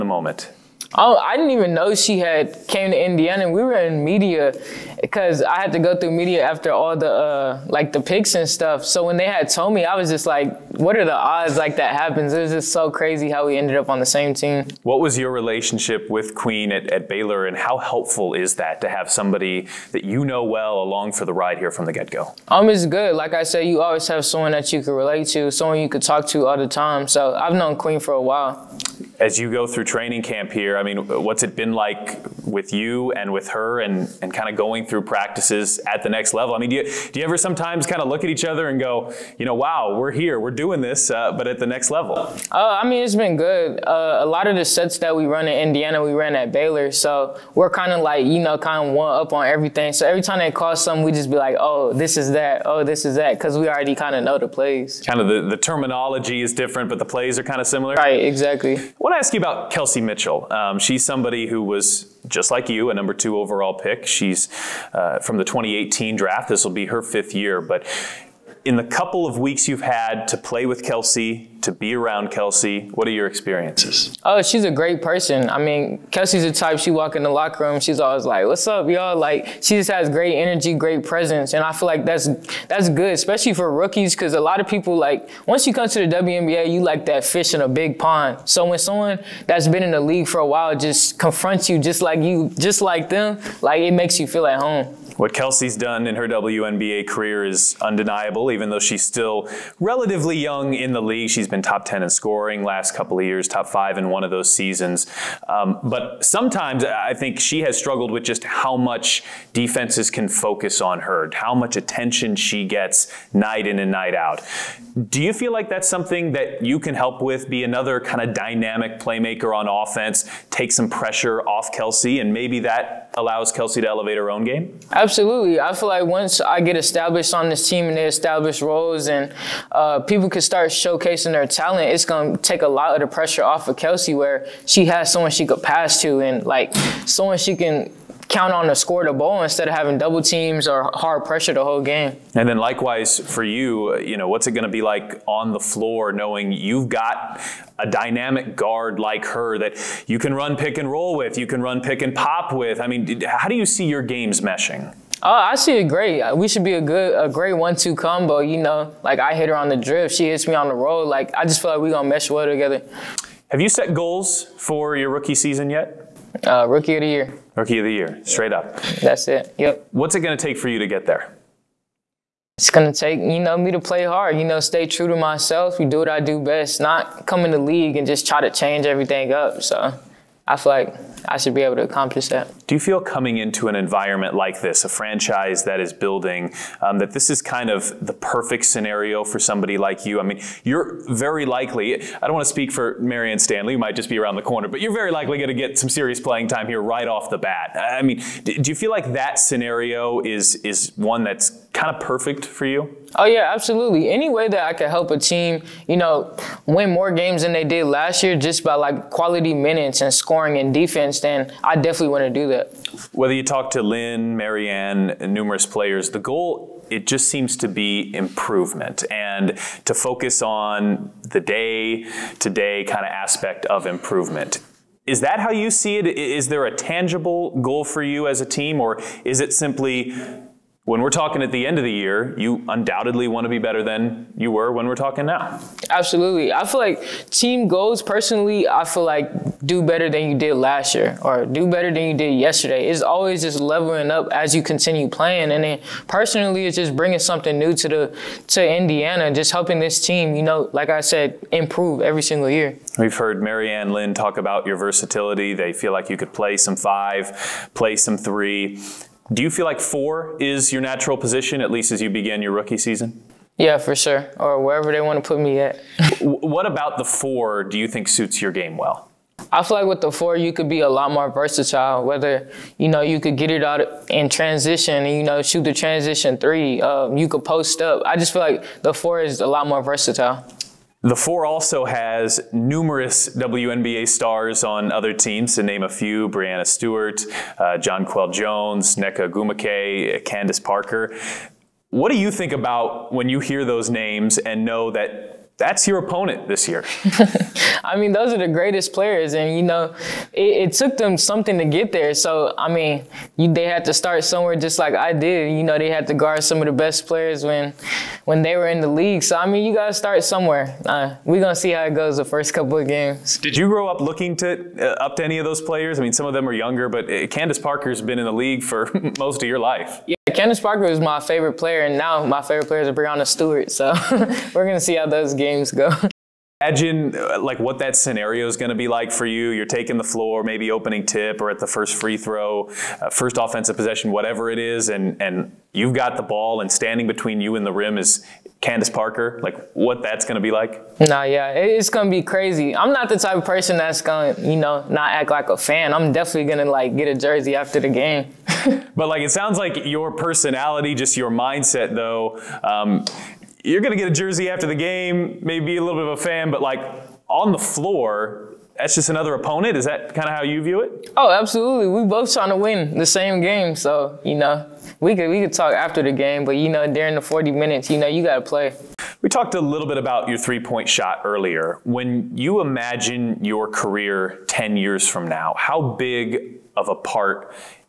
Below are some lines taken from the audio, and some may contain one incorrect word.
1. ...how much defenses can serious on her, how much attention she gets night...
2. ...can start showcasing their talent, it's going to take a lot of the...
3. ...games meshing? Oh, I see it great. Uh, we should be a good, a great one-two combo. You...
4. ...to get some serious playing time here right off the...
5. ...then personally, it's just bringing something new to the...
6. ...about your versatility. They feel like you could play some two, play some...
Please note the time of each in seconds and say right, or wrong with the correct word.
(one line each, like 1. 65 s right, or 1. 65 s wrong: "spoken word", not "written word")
1. 108 s wrong: "focus", not "serious"
2. 130 s right
3. 154 s right
4. 195 s right
5. 245 s right
6. 254 s wrong: "five", not "two".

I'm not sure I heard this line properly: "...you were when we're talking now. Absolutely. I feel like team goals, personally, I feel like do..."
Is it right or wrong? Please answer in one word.
right.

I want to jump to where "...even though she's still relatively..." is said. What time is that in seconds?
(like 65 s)
98 s.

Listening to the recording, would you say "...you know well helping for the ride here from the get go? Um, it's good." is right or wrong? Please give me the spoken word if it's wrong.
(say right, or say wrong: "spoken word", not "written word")
wrong: "along", not "helping".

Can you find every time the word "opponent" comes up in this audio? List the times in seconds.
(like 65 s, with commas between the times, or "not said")
295 s, 359 s.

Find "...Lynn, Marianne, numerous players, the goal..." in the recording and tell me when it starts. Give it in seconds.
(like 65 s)
213 s.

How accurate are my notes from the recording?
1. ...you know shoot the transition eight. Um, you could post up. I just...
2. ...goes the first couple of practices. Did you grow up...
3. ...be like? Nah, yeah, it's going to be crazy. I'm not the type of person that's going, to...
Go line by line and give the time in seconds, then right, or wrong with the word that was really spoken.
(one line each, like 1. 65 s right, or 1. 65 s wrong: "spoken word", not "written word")
1. 275 s wrong: "three", not "eight"
2. 311 s wrong: "games", not "practices"
3. 340 s right.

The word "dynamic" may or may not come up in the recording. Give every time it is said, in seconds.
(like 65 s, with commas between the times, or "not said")
118 s, 147 s.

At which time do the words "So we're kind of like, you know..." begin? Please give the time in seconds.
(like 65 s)
46 s.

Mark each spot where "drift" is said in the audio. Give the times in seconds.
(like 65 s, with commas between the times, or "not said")
159 s.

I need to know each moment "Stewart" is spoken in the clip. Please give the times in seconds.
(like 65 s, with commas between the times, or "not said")
286 s, 323 s.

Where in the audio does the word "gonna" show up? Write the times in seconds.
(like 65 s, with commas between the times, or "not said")
161 s, 311 s, 324 s.